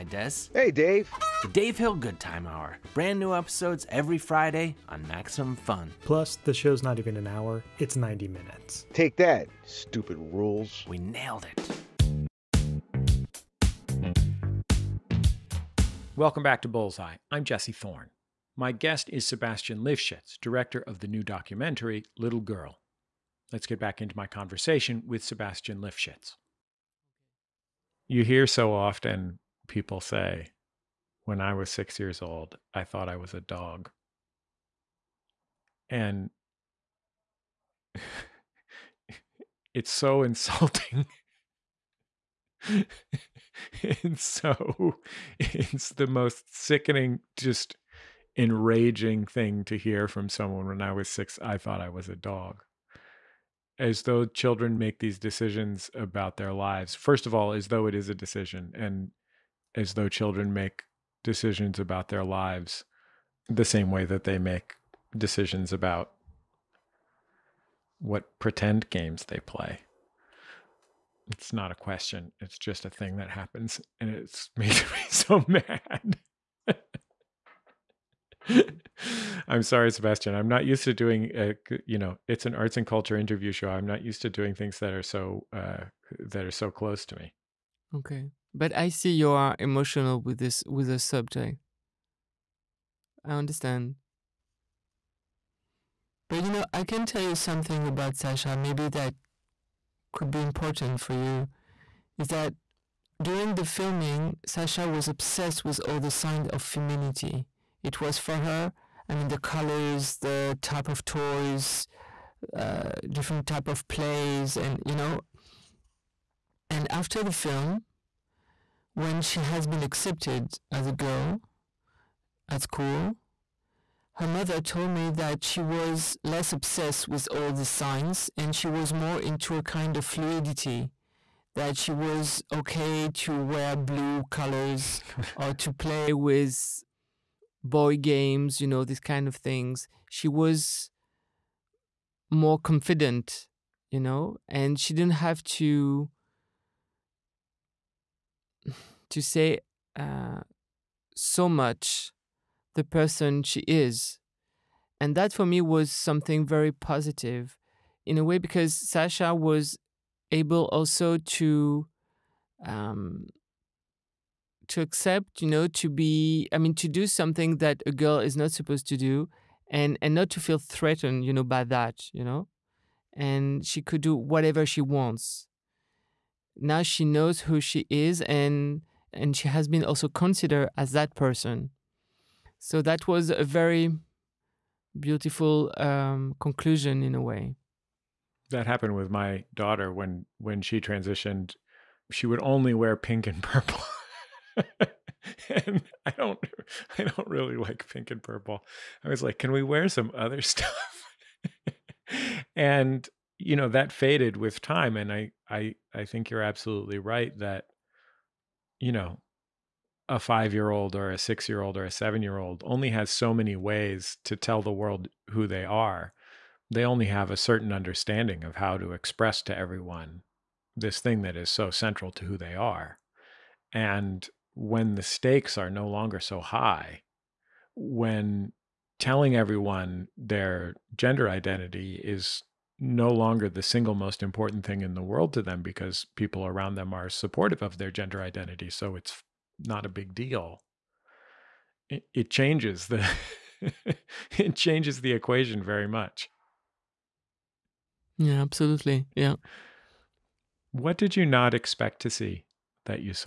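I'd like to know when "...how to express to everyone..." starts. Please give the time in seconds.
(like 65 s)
218 s.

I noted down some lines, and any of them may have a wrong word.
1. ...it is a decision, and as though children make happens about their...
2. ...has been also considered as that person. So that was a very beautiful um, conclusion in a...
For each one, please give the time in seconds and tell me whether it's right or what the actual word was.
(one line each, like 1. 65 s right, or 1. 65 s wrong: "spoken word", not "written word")
1. 57 s wrong: "decisions", not "happens"
2. 179 s right.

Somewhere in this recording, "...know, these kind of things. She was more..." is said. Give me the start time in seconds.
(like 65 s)
138 s.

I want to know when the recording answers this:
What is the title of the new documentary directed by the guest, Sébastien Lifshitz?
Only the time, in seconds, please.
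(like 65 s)
22 s.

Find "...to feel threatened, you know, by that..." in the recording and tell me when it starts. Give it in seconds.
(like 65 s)
170 s.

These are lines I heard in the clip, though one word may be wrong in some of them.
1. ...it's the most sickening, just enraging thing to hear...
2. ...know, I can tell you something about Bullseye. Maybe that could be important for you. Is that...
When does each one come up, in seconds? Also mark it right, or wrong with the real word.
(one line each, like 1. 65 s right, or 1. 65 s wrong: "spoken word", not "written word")
1. 45 s right
2. 96 s wrong: "Sasha", not "Bullseye".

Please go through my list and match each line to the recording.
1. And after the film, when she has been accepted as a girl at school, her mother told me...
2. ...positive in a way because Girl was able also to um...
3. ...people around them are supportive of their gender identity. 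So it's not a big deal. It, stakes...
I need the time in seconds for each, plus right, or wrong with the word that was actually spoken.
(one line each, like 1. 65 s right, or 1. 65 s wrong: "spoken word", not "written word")
1. 116 s right
2. 156 s wrong: "Sasha", not "Girl"
3. 236 s wrong: "changes", not "stakes".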